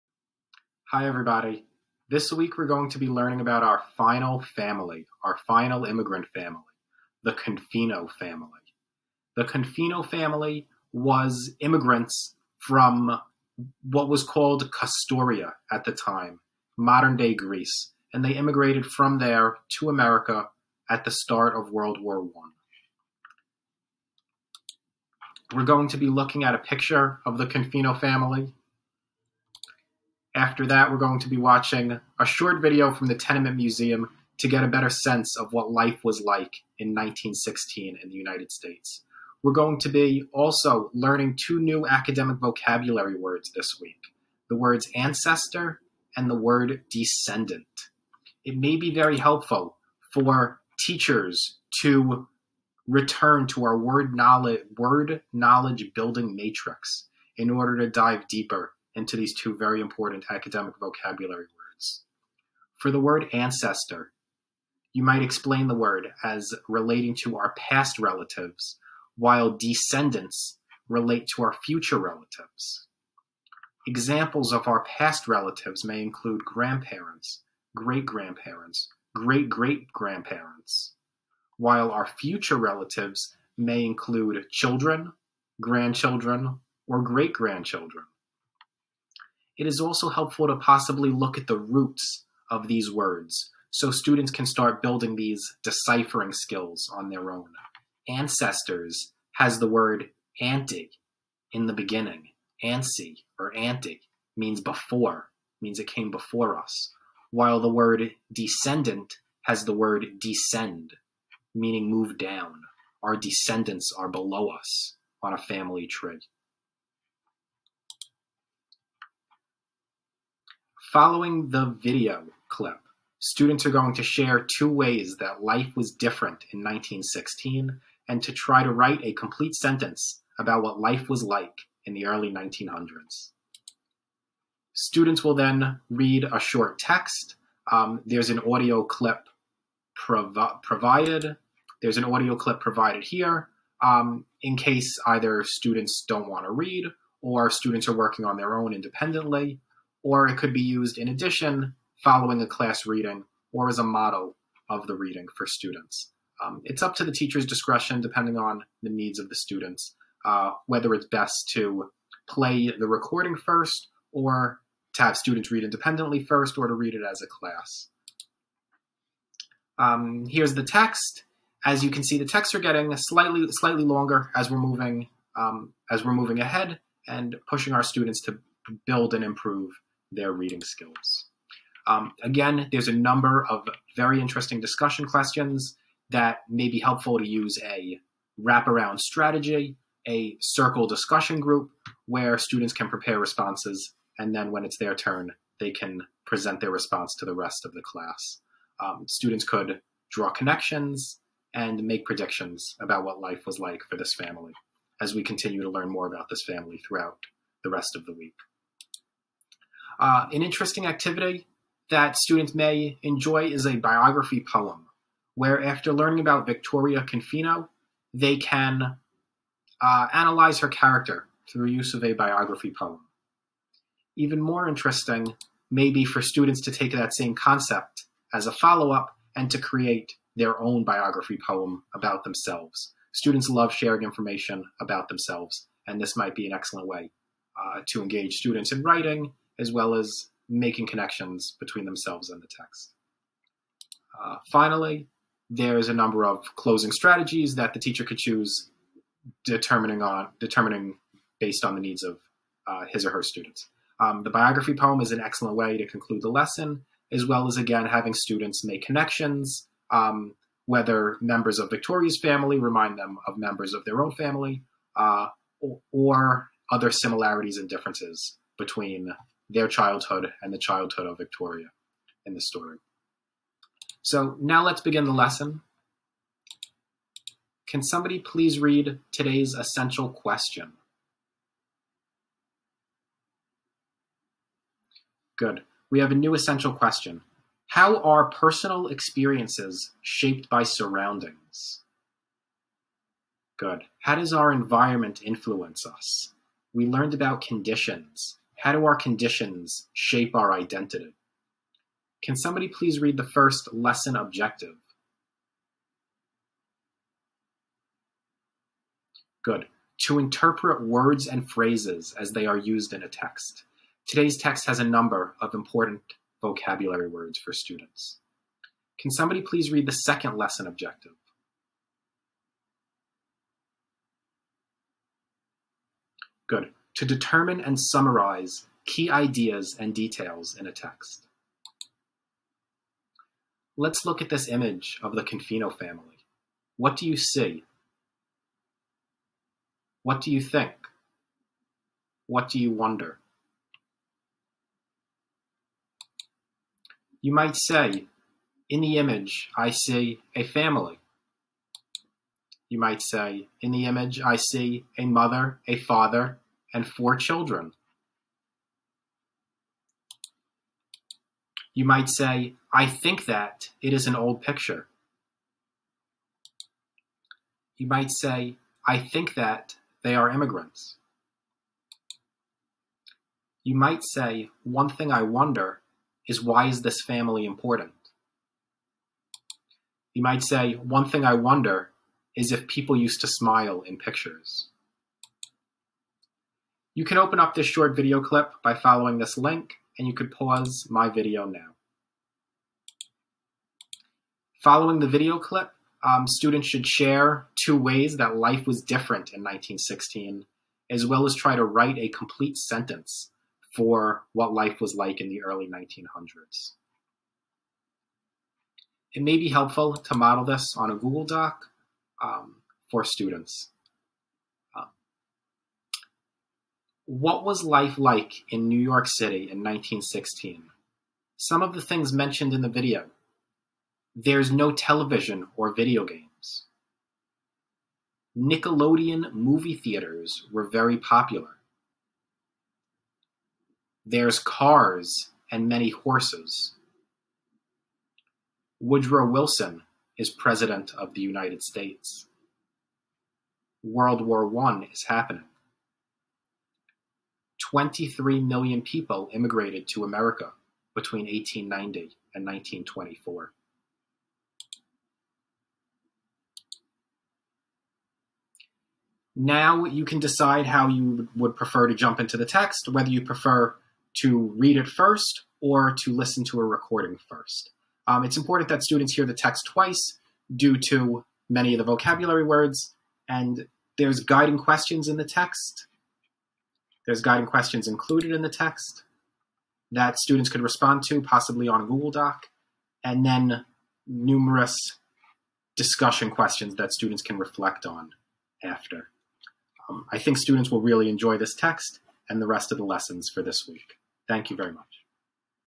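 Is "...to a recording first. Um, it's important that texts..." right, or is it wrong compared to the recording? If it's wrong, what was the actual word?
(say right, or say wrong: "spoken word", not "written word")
wrong: "students", not "texts".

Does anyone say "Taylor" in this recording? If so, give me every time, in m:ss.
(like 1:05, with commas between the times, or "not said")
not said.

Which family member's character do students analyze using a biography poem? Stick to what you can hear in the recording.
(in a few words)
Victoria Confino.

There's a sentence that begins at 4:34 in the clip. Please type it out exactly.
So now let's begin the lesson.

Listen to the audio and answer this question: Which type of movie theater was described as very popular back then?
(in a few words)
Nickelodeon.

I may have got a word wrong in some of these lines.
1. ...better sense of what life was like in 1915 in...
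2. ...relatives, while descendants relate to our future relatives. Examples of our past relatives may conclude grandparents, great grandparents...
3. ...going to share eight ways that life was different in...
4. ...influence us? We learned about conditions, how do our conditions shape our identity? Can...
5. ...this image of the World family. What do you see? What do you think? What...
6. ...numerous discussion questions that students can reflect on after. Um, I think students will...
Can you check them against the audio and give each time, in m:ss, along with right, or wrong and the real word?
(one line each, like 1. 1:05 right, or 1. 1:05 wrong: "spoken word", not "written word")
1. 0:34 wrong: "1916", not "1915"
2. 1:07 wrong: "include", not "conclude"
3. 2:03 wrong: "two", not "eight"
4. 4:55 right
5. 5:34 wrong: "Confino", not "World"
6. 8:04 right.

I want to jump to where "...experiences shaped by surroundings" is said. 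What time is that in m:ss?
4:48.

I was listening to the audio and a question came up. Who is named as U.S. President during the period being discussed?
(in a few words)
Woodrow Wilson.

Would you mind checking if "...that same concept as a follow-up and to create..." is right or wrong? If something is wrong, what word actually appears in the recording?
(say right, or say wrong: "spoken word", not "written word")
right.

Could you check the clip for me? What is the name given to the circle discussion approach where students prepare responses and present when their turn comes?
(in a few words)
wraparound strategy.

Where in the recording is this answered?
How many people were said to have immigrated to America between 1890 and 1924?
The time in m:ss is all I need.
7:27.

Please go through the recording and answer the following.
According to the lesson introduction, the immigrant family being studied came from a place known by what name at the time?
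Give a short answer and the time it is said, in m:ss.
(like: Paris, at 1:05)
Castoria, at 0:14.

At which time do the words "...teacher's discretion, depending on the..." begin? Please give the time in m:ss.
2:37.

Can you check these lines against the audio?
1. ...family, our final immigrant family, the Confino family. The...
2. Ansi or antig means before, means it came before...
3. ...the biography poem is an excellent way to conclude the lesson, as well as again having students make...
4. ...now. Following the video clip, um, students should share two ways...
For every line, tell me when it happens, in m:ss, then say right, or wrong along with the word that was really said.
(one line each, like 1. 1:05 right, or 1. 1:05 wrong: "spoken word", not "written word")
1. 0:04 right
2. 1:42 right
3. 4:14 right
4. 6:31 right.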